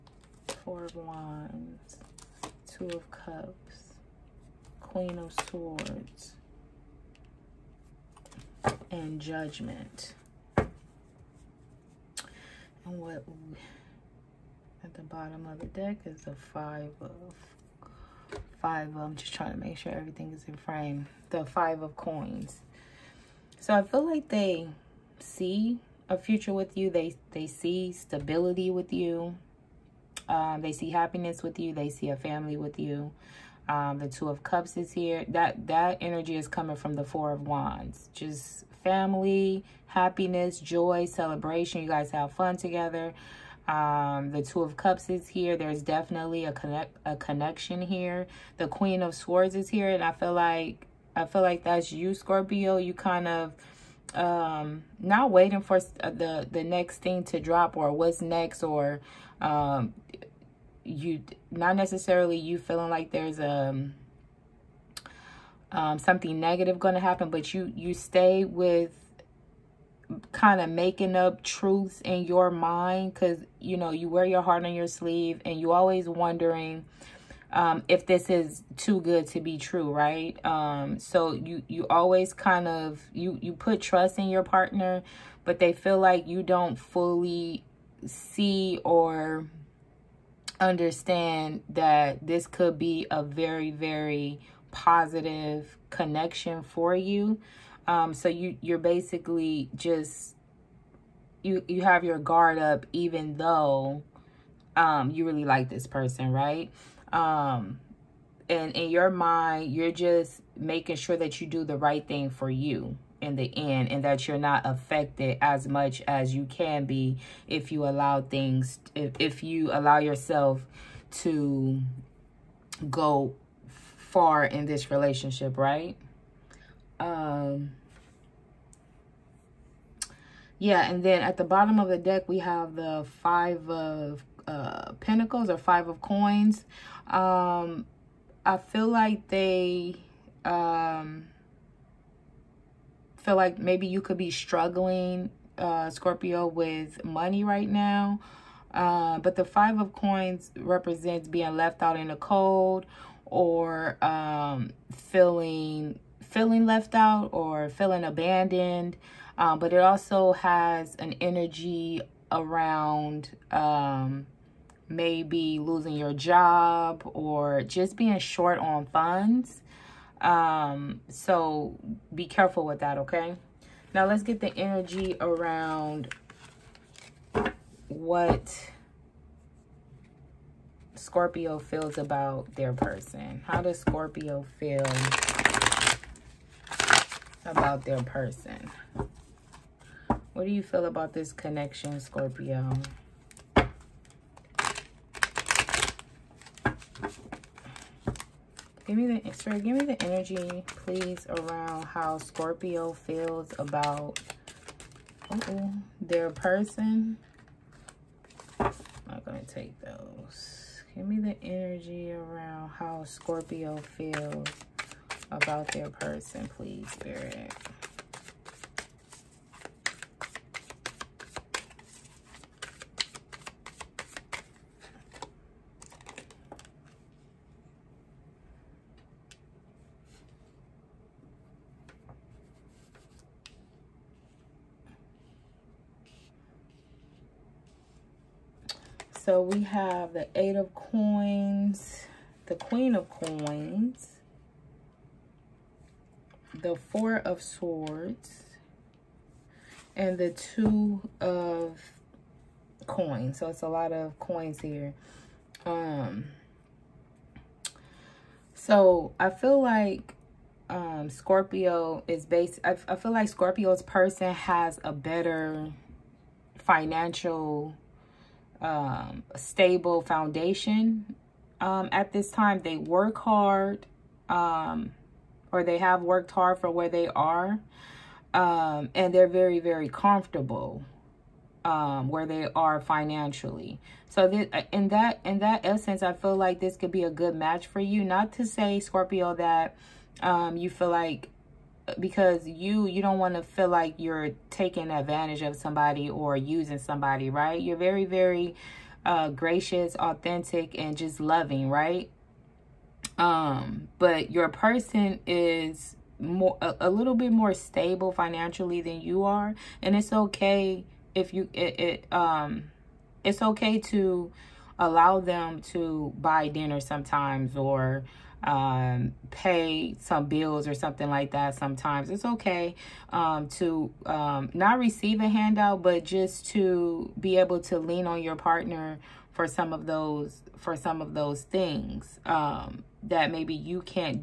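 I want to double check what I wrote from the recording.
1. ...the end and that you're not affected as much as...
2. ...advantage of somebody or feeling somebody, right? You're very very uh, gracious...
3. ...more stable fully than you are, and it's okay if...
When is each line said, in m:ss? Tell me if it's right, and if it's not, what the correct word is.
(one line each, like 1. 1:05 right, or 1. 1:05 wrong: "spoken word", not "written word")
1. 1:53 right
2. 4:54 wrong: "using", not "feeling"
3. 5:07 wrong: "financially", not "fully".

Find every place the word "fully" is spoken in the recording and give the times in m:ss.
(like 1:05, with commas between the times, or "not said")
1:26.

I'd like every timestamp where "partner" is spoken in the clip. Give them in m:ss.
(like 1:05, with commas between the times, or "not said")
1:24, 5:28.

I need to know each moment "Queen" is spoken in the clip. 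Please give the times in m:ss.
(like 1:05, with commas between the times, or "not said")
0:04, 0:48, 4:02.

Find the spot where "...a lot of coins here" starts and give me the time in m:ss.
4:13.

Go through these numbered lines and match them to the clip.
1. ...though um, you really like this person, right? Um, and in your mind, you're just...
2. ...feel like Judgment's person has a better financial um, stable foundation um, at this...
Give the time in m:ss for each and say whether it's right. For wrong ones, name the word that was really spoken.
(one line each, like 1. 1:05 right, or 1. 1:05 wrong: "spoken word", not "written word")
1. 1:43 right
2. 4:22 wrong: "Scorpio", not "Judgment".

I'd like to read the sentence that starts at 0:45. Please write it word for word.
There's definitely a connect a connection here.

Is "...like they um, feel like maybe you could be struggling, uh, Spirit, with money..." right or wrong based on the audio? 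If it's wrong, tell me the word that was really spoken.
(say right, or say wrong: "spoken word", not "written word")
wrong: "Scorpio", not "Spirit".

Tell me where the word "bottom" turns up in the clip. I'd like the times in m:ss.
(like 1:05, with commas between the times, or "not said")
0:15, 2:11.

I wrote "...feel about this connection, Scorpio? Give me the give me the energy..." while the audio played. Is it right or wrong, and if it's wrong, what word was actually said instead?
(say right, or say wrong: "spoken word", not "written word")
right.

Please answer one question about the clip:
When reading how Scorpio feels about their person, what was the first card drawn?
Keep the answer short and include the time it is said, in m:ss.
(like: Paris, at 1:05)
Eight of Coins, at 4:00.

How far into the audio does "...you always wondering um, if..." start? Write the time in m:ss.
1:15.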